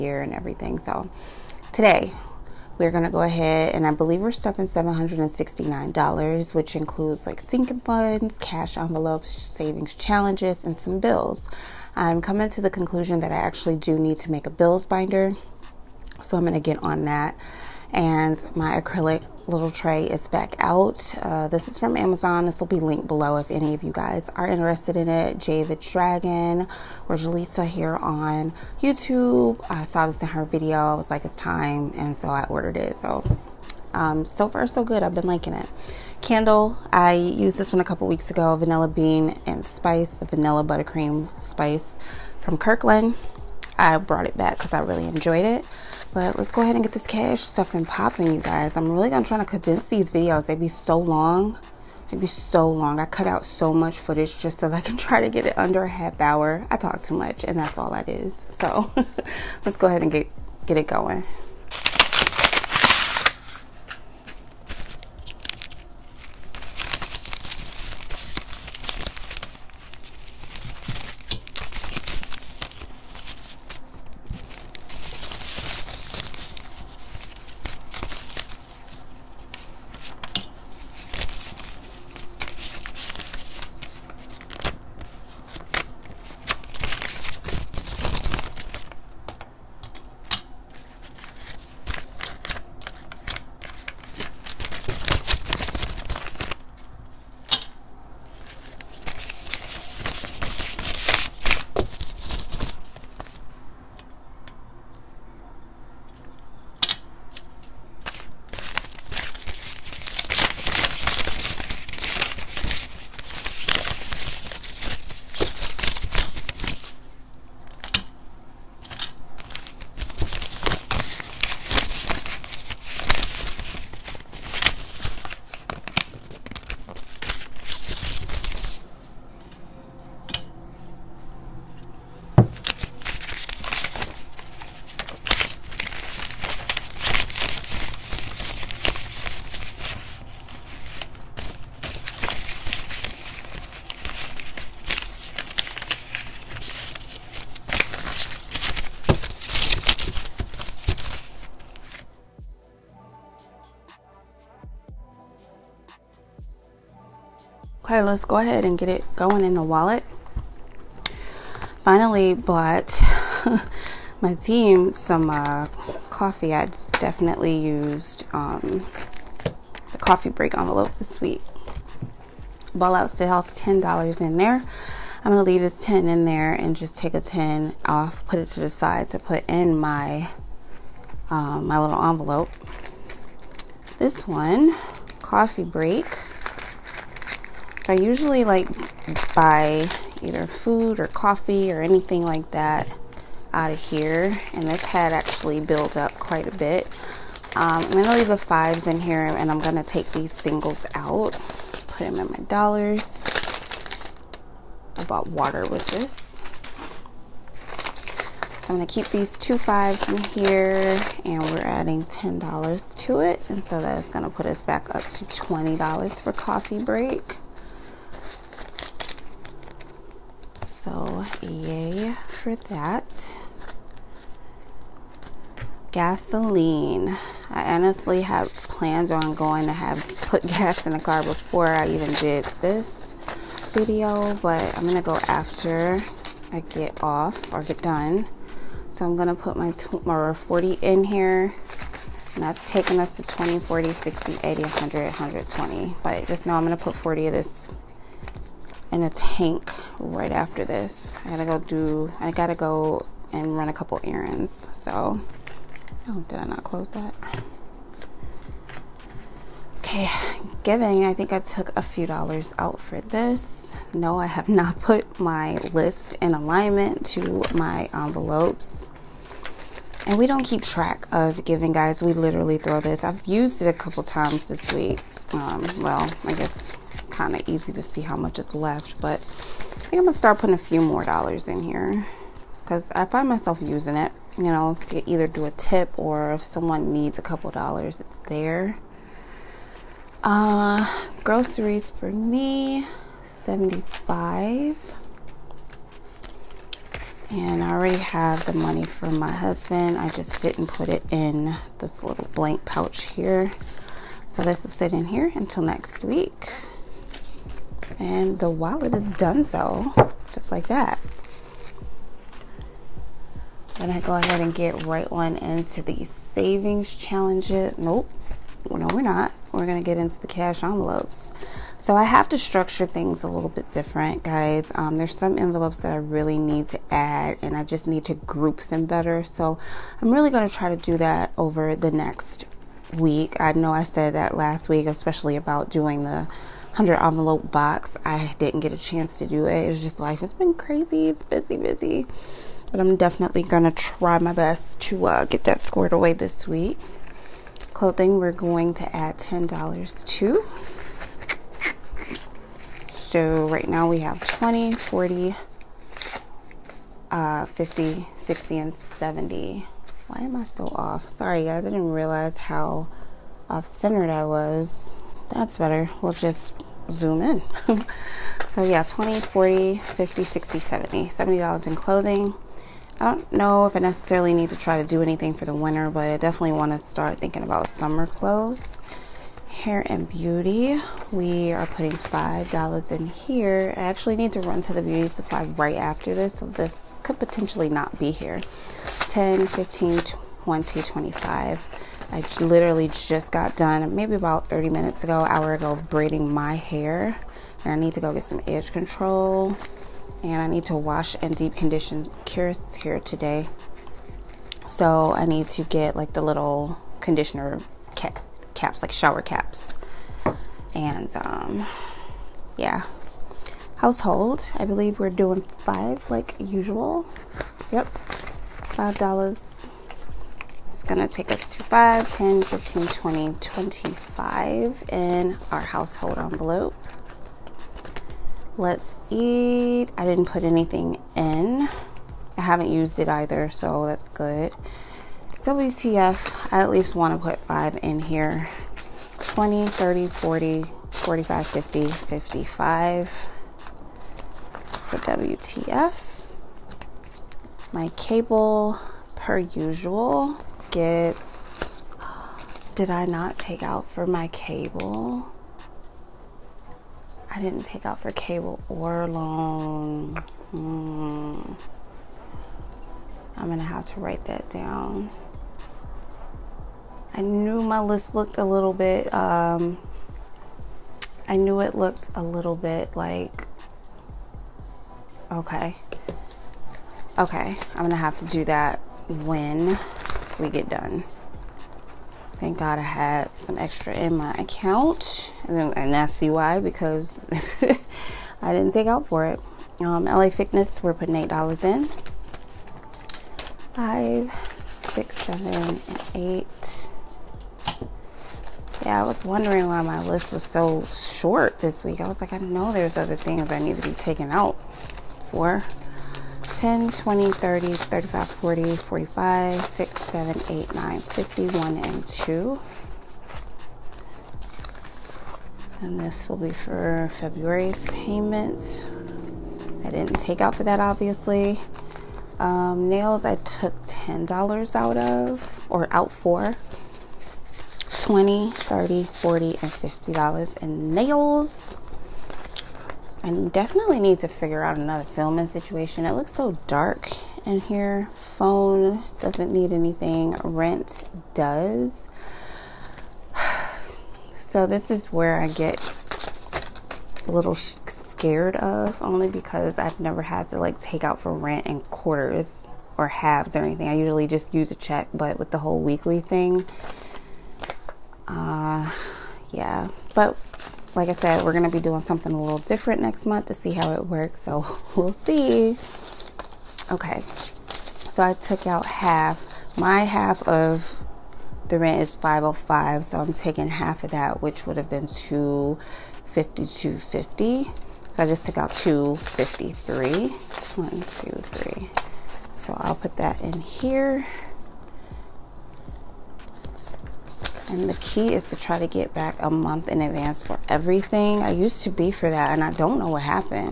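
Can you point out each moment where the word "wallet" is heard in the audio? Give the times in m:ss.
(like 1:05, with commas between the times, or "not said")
2:39, 5:08.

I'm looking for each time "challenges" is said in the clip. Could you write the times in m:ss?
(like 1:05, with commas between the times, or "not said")
0:09, 5:16.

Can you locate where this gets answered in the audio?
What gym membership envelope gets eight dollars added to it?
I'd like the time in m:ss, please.
8:10.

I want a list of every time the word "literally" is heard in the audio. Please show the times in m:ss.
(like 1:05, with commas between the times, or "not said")
4:32, 6:32.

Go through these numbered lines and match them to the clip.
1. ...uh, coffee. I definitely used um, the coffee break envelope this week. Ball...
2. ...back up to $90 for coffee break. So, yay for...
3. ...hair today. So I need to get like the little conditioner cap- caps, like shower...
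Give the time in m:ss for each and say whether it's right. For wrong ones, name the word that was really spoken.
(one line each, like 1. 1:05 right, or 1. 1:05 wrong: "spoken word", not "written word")
1. 2:45 right
2. 3:34 wrong: "20", not "90"
3. 6:42 right.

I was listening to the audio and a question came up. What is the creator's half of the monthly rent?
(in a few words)
505.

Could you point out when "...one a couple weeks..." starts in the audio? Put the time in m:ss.
0:37.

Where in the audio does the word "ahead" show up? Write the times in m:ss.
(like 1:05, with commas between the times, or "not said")
0:03, 0:46, 0:59, 2:38, 5:14.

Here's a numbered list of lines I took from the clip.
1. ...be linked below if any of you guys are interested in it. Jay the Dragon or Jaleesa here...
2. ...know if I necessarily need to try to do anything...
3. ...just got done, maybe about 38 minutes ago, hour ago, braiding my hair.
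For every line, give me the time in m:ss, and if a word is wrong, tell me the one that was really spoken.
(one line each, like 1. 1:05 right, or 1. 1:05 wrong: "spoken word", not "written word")
1. 0:22 right
2. 6:13 right
3. 6:32 wrong: "30", not "38".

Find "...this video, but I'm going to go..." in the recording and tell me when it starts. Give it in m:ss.
3:52.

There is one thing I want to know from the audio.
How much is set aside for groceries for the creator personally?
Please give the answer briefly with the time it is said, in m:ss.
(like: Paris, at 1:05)
75, at 4:53.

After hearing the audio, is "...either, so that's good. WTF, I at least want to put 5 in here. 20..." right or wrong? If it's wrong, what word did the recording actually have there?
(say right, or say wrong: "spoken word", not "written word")
right.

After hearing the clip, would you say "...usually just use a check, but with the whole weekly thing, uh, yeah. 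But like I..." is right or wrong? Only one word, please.
right.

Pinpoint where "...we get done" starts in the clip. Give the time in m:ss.
8:00.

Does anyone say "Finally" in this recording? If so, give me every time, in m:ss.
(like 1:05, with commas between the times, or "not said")
2:41.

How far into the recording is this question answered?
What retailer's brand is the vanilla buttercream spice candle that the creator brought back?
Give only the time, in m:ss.
0:42.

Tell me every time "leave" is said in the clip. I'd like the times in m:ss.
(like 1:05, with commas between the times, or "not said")
2:55, 3:18.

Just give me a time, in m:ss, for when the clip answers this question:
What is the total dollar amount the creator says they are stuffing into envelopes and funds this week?
0:04.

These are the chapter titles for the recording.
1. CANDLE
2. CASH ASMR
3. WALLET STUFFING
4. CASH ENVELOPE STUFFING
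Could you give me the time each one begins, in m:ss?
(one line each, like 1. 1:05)
1. 0:35
2. 1:01
3. 2:37
4. 5:16.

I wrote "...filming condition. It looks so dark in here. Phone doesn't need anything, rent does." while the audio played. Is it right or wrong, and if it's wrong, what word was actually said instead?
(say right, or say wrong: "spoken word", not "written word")
wrong: "situation", not "condition".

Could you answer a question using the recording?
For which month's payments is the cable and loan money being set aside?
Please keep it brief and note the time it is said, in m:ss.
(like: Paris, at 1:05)
February, at 8:37.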